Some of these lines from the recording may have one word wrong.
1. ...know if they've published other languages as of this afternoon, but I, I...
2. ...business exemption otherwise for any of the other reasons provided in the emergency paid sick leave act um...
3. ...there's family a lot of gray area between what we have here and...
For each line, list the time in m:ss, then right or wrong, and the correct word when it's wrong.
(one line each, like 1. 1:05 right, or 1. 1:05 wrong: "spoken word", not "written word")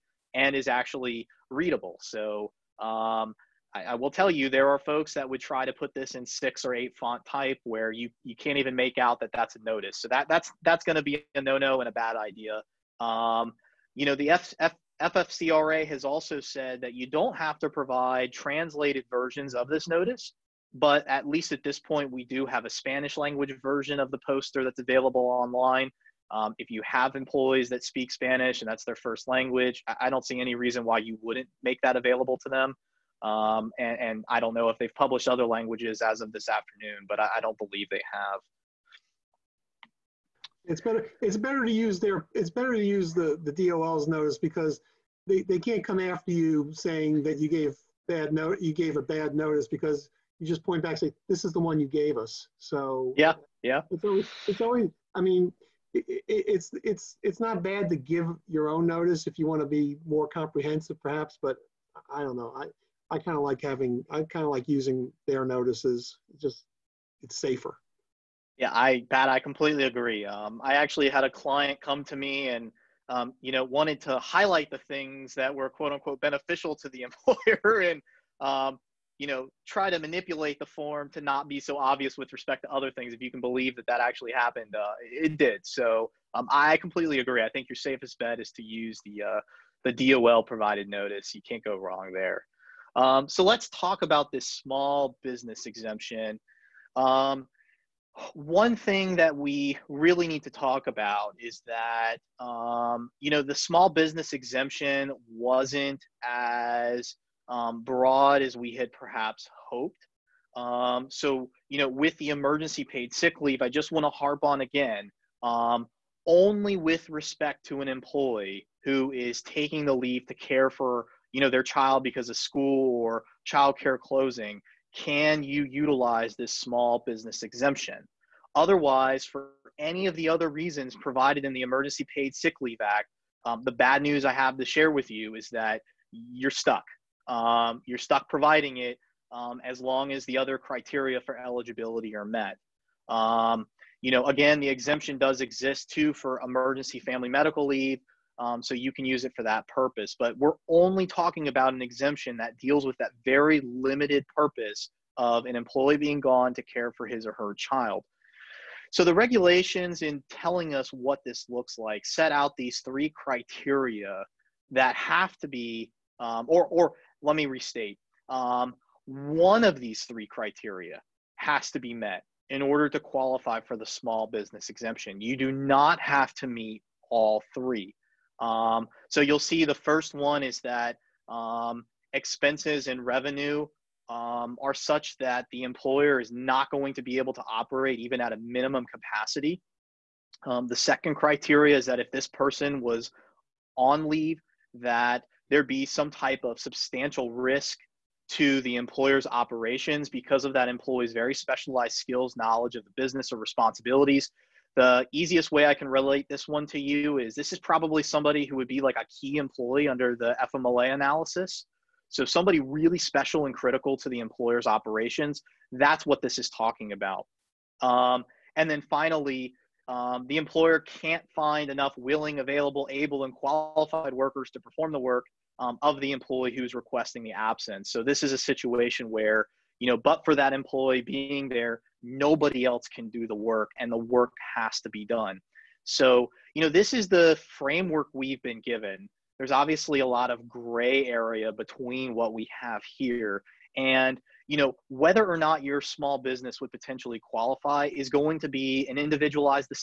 1. 0:34 right
2. 2:07 right
3. 3:59 wrong: "obviously", not "family".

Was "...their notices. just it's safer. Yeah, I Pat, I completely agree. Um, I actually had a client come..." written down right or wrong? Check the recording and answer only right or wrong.
right.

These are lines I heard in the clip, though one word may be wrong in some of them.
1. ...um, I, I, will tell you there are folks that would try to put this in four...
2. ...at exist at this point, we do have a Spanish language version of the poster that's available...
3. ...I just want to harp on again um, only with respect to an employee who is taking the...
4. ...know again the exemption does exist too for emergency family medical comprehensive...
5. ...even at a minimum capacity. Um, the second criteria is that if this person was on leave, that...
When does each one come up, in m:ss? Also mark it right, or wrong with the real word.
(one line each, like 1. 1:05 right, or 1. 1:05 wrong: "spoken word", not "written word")
1. 0:02 wrong: "six", not "four"
2. 0:21 wrong: "least", not "exist"
3. 1:53 right
4. 2:24 wrong: "leave", not "comprehensive"
5. 3:07 right.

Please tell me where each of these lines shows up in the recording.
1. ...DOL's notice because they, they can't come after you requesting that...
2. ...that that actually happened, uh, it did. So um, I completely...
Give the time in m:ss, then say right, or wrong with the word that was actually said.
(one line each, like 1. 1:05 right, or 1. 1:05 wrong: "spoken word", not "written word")
1. 0:43 wrong: "saying", not "requesting"
2. 1:23 right.